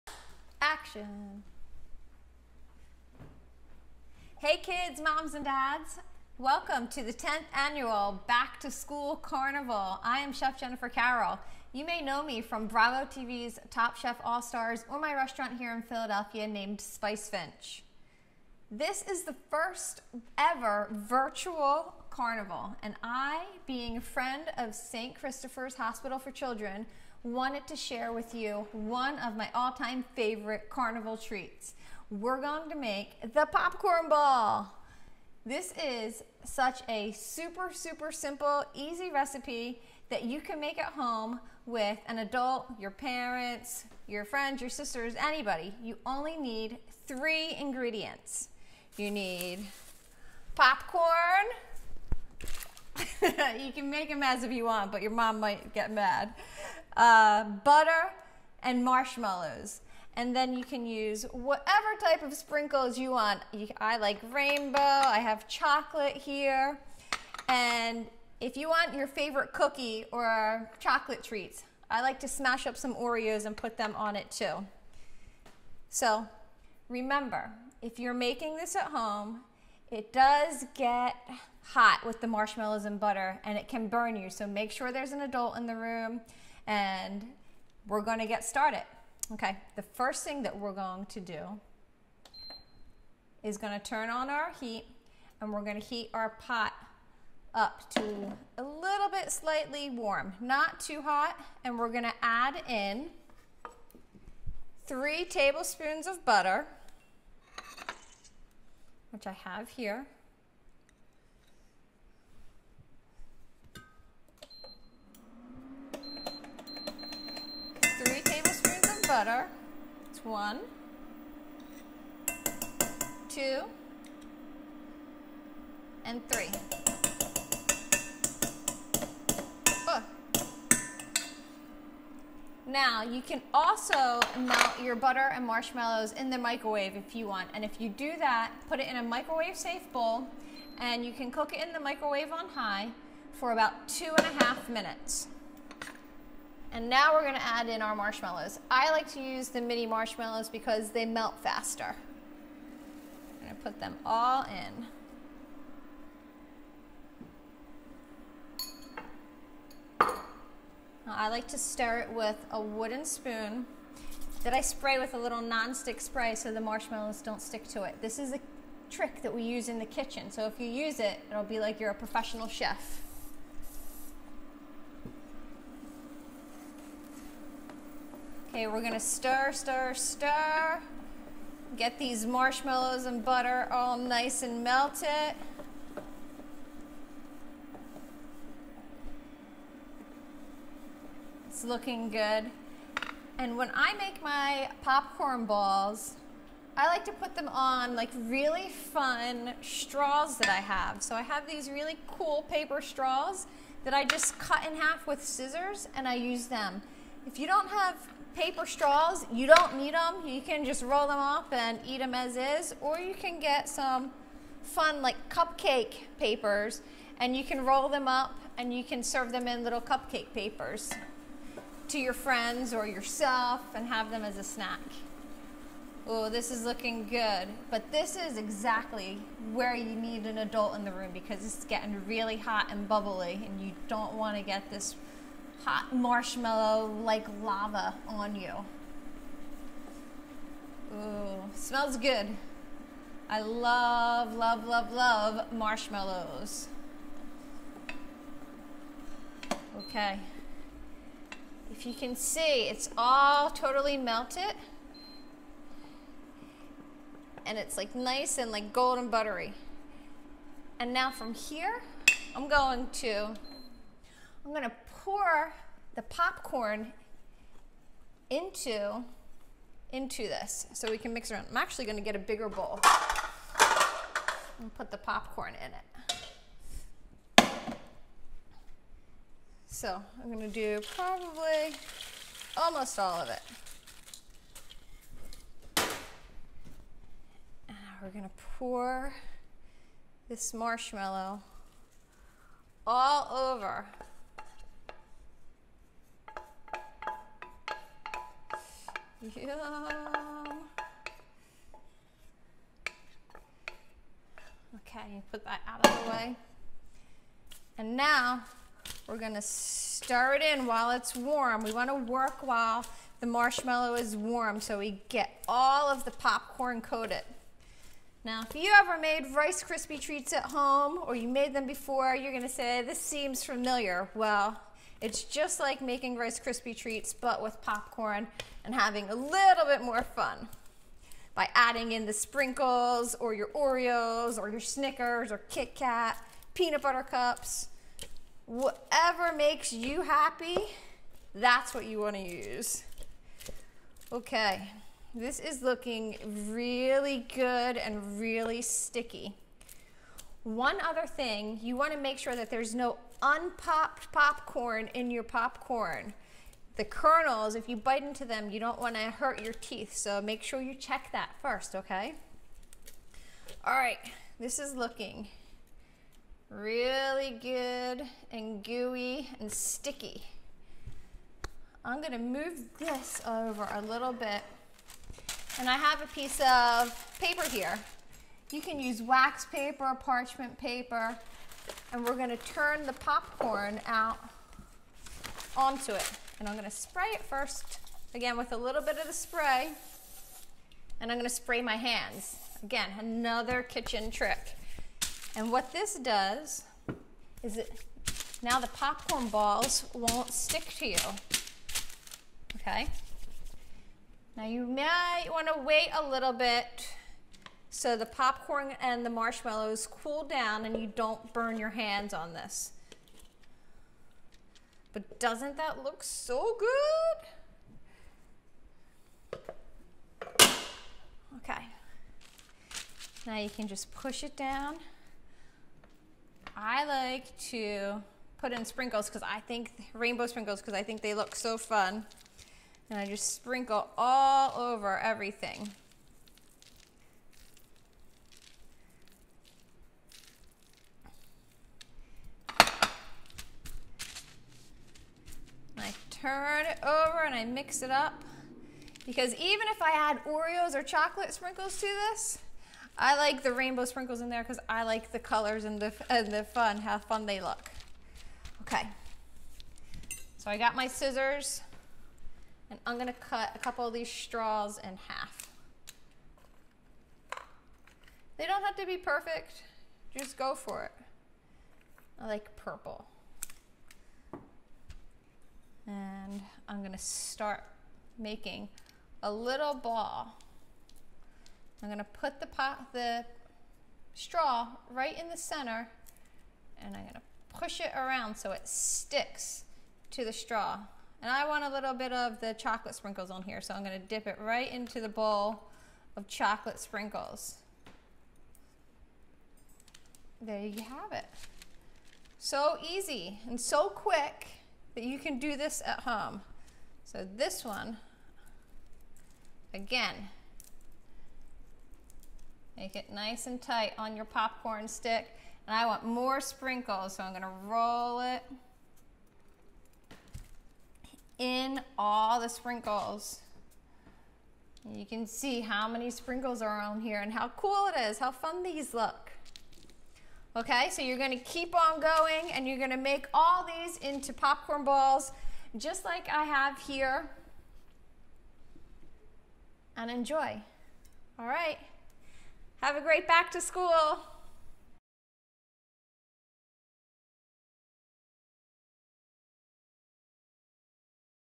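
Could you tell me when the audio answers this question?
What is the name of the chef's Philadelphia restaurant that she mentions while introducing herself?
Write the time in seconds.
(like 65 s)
16 s.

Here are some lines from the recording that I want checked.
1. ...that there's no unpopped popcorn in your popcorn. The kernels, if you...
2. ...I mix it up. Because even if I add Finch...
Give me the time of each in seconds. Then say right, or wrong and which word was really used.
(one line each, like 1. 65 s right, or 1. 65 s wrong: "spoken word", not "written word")
1. 352 s right
2. 447 s wrong: "Oreos", not "Finch".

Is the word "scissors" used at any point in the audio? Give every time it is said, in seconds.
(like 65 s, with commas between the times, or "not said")
205 s, 460 s.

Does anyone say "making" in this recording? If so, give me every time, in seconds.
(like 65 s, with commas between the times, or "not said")
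78 s, 325 s, 478 s.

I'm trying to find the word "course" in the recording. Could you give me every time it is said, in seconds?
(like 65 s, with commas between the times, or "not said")
not said.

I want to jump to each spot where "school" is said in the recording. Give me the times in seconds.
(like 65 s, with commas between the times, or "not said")
8 s, 543 s.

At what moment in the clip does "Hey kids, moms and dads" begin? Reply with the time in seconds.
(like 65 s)
4 s.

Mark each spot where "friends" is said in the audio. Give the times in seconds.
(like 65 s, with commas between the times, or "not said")
24 s, 44 s, 222 s.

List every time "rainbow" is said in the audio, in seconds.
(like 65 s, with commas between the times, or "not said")
64 s, 429 s, 453 s.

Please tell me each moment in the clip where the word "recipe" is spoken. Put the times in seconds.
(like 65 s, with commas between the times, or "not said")
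39 s.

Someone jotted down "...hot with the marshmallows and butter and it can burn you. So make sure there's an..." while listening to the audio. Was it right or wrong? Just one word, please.
right.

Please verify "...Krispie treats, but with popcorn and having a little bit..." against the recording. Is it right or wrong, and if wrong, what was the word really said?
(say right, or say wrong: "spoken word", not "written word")
right.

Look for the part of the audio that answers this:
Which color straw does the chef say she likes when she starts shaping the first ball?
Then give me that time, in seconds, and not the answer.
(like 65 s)
472 s.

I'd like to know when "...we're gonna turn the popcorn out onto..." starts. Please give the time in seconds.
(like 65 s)
382 s.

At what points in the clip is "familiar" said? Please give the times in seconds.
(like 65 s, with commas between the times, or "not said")
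323 s.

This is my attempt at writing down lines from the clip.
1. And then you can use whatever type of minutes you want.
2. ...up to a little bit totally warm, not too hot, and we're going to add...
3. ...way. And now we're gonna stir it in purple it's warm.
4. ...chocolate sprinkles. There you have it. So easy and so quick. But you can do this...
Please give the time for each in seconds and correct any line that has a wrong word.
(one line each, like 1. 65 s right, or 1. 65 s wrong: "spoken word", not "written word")
1. 60 s wrong: "sprinkles", not "minutes"
2. 97 s wrong: "slightly", not "totally"
3. 306 s wrong: "while", not "purple"
4. 496 s right.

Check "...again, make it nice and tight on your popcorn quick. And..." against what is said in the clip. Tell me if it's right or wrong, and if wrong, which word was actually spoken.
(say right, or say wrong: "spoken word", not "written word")
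wrong: "stick", not "quick".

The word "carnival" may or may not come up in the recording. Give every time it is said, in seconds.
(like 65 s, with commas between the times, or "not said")
9 s, 22 s, 30 s.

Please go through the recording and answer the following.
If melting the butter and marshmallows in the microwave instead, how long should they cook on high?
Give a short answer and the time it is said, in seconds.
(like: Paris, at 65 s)
2.5 minutes, at 143 s.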